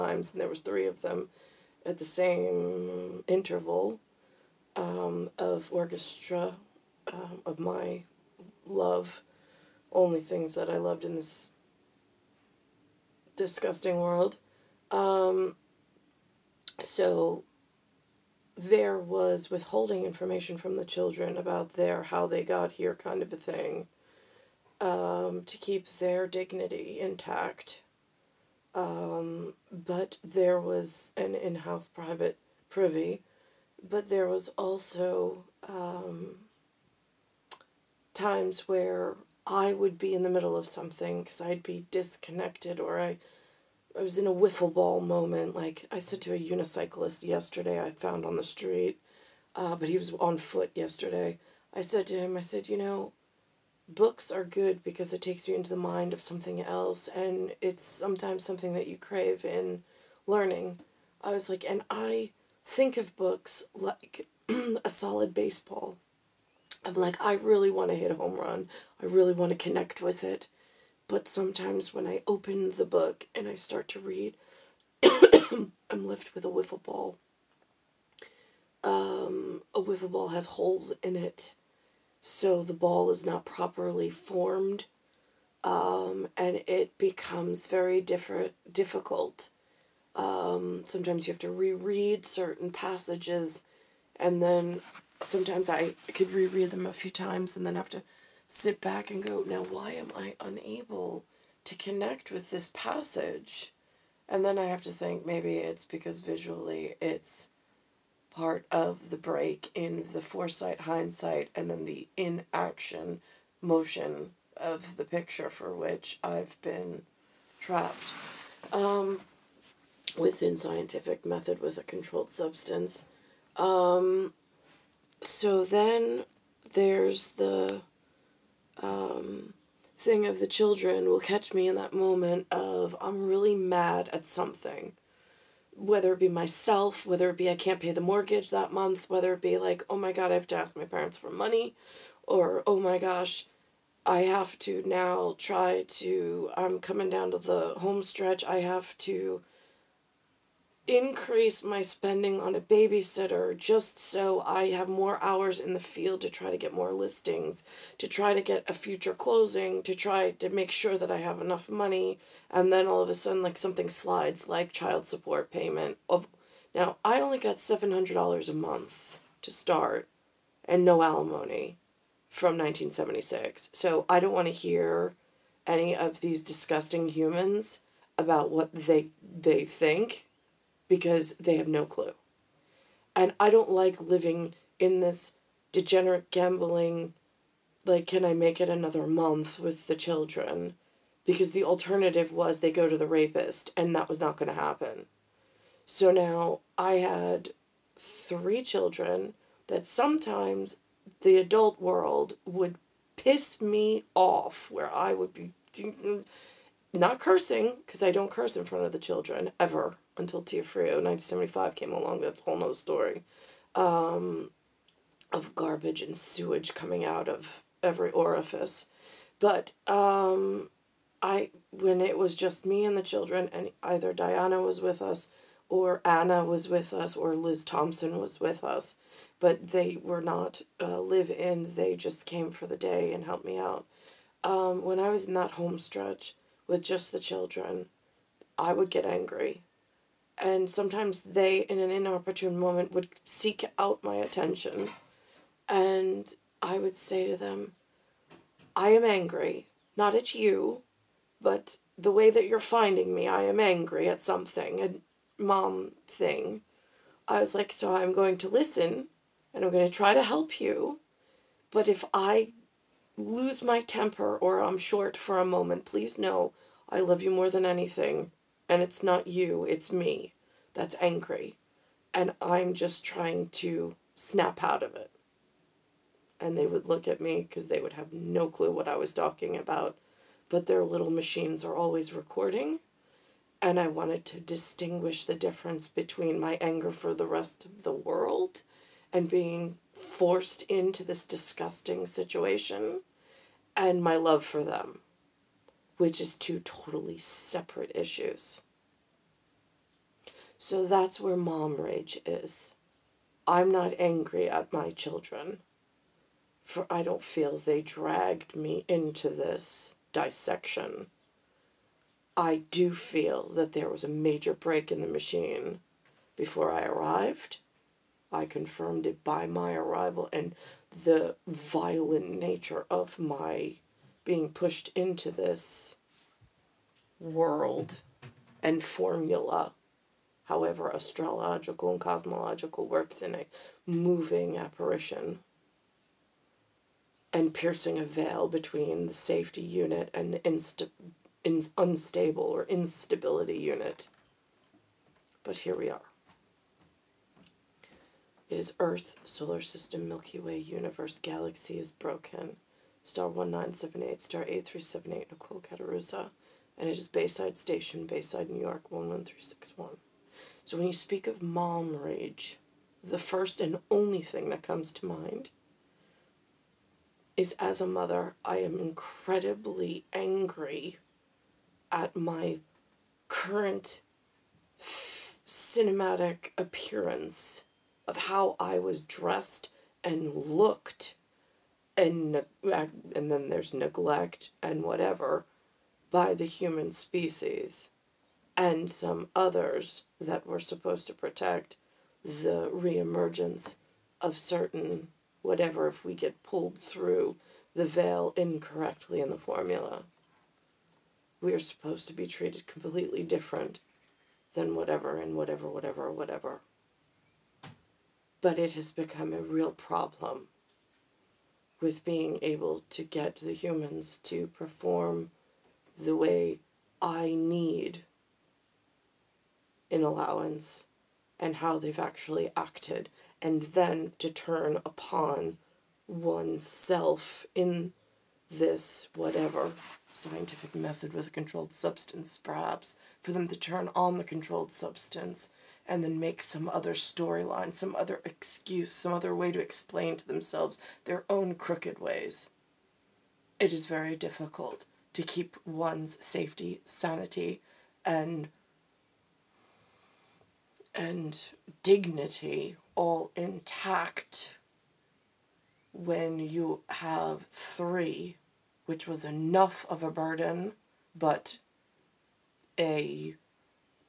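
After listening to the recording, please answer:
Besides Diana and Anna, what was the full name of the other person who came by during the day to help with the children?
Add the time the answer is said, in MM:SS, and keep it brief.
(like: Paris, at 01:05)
Liz Thompson, at 03:47.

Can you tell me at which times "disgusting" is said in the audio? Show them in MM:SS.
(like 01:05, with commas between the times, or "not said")
00:13, 02:56, 04:51.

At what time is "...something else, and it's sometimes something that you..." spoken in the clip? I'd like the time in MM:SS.
00:56.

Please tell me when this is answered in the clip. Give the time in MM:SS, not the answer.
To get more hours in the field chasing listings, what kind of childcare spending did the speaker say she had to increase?
02:32.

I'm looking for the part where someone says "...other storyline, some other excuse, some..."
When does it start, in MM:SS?
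07:16.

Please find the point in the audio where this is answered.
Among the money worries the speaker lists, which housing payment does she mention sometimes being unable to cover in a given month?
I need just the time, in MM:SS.
02:18.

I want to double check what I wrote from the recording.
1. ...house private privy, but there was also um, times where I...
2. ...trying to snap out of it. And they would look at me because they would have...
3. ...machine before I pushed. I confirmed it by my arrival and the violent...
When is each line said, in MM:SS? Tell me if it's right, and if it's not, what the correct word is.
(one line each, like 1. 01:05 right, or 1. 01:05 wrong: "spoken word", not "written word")
1. 00:31 right
2. 04:33 right
3. 05:15 wrong: "arrived", not "pushed".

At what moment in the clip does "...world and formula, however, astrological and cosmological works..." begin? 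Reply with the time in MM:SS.
05:27.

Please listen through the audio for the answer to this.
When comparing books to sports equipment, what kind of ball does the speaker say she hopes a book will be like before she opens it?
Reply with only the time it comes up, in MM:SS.
01:04.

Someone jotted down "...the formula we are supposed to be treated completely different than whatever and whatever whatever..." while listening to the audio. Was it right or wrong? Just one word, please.
right.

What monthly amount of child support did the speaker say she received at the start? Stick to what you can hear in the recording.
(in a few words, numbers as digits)
$700.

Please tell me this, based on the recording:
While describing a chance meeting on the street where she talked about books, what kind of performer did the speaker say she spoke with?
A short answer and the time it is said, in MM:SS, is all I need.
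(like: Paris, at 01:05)
unicyclist, at 00:46.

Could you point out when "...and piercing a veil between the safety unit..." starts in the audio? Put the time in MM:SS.
05:37.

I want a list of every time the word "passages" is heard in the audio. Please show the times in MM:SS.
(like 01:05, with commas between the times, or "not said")
01:32, 01:42.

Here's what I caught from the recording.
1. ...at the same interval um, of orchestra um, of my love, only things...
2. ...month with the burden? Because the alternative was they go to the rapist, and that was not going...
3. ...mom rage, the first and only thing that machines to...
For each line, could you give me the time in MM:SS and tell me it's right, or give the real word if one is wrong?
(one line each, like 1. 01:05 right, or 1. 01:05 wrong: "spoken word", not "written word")
1. 00:01 right
2. 03:09 wrong: "children", not "burden"
3. 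06:01 wrong: "comes", not "machines".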